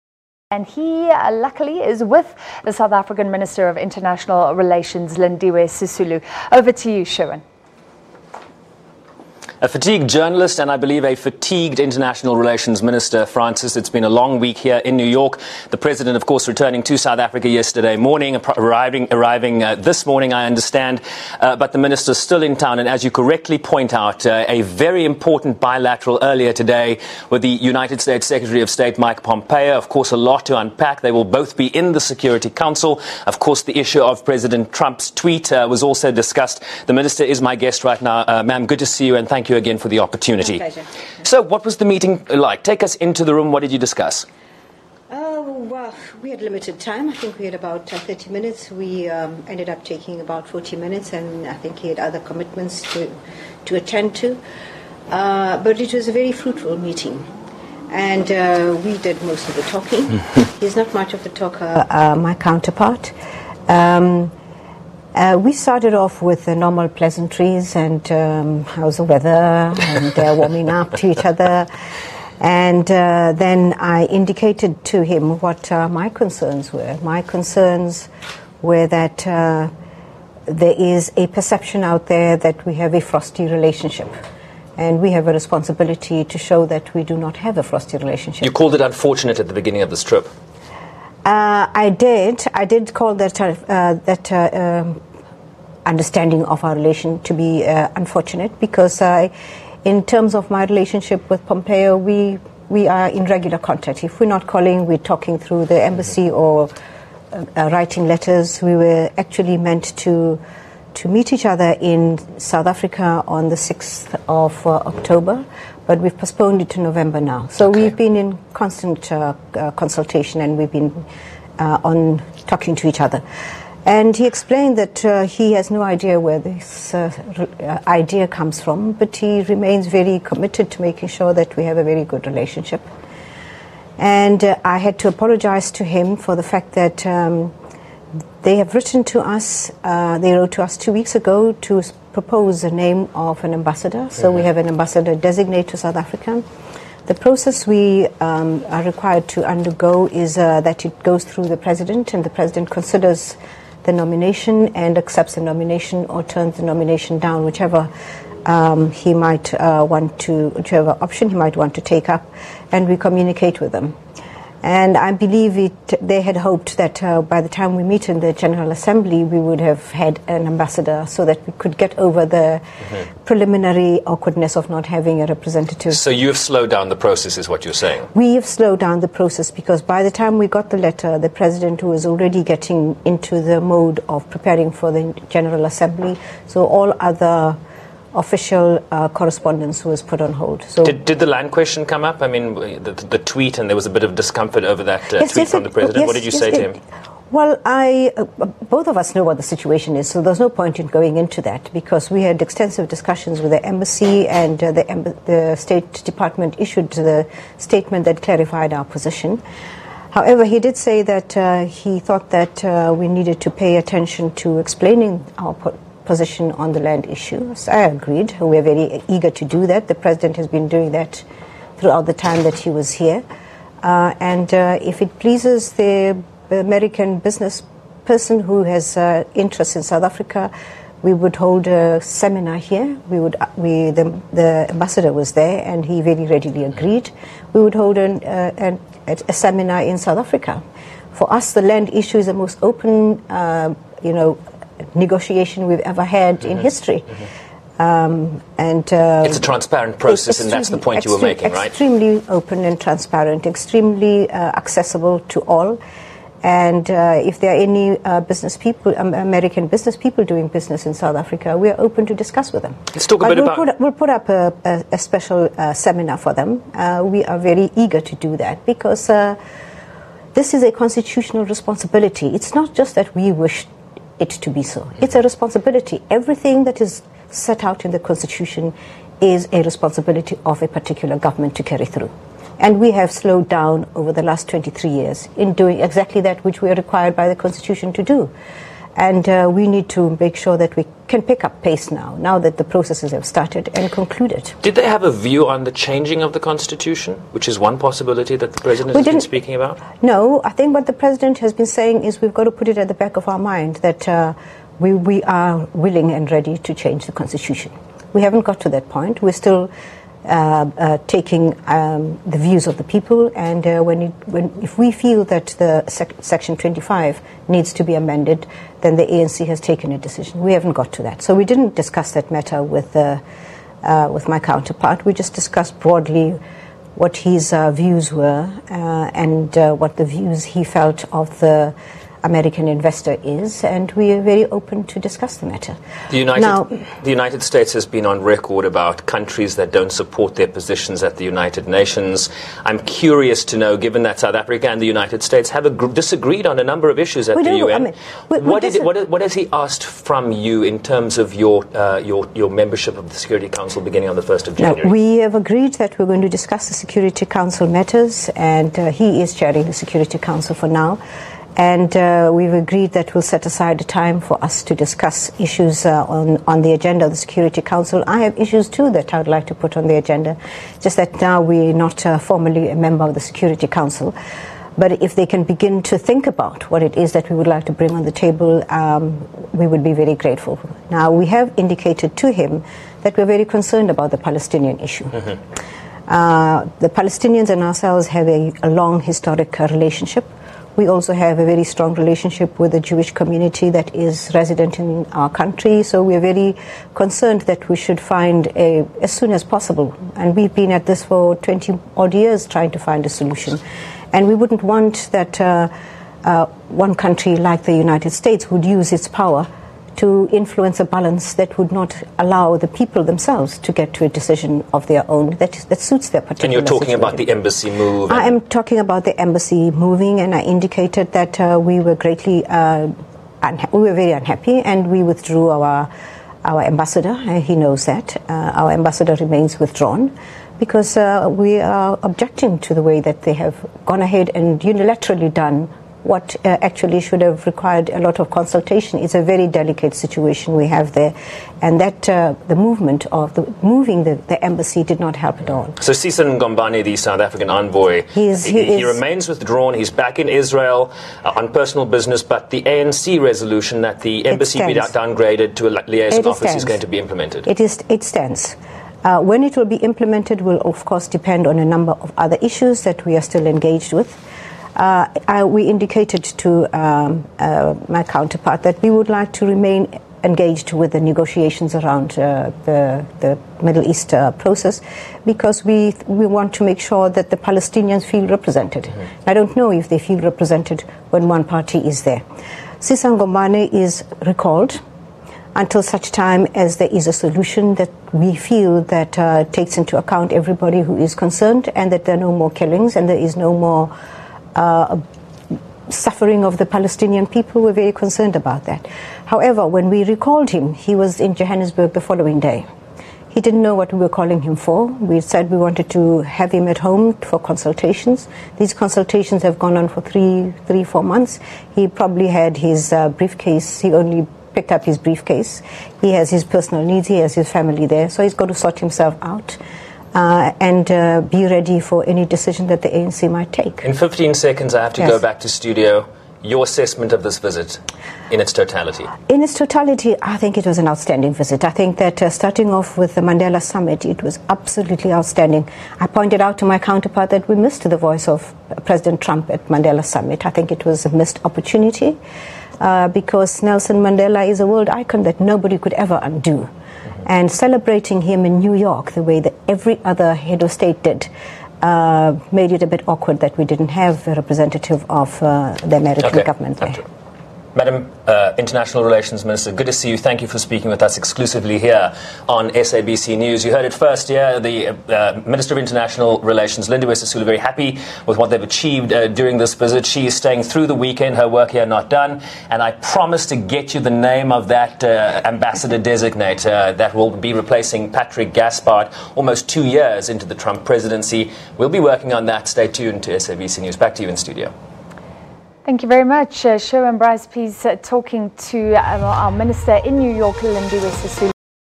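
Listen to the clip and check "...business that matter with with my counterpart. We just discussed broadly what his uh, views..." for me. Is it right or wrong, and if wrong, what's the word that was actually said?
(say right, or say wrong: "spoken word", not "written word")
wrong: "discuss", not "business".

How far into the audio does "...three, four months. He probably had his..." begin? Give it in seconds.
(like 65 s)
510 s.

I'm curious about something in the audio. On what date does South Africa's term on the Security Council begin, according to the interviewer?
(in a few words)
1st of January.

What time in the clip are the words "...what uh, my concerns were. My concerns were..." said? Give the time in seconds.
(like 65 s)
75 s.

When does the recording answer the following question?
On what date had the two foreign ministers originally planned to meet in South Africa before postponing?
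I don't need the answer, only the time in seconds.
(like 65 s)
113 s.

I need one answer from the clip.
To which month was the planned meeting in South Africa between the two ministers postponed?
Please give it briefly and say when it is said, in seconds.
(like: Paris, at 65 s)
November, at 116 s.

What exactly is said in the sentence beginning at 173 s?
preliminary awkwardness of not having a representative.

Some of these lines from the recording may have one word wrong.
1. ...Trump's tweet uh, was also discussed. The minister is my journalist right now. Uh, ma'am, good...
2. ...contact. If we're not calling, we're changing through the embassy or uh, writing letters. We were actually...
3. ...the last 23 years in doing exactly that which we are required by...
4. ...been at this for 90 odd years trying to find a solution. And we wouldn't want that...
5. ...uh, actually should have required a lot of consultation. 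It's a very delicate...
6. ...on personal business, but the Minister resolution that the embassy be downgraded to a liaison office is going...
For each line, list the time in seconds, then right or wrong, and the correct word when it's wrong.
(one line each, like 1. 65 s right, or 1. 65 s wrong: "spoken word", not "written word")
1. 34 s wrong: "guest", not "journalist"
2. 103 s wrong: "talking", not "changing"
3. 284 s right
4. 400 s wrong: "20", not "90"
5. 436 s right
6. 451 s wrong: "ANC", not "Minister".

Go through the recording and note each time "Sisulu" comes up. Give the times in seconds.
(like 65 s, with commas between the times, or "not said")
5 s, 567 s, 591 s.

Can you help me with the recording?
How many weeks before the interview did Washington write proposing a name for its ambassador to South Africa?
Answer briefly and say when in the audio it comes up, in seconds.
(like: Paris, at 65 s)
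2 weeks, at 140 s.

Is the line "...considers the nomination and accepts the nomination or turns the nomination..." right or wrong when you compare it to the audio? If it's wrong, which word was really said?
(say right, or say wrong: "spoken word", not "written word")
right.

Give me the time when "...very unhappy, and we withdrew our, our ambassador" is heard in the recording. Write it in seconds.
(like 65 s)
424 s.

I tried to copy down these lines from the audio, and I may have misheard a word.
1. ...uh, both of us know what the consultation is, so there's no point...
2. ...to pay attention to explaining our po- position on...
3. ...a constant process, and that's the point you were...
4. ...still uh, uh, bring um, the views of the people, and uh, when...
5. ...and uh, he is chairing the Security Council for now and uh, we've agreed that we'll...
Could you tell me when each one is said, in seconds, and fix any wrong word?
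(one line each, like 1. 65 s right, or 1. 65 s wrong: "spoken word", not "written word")
1. 198 s wrong: "situation", not "consultation"
2. 213 s right
3. 249 s wrong: "transparent", not "constant"
4. 309 s wrong: "taking", not "bring"
5. 358 s right.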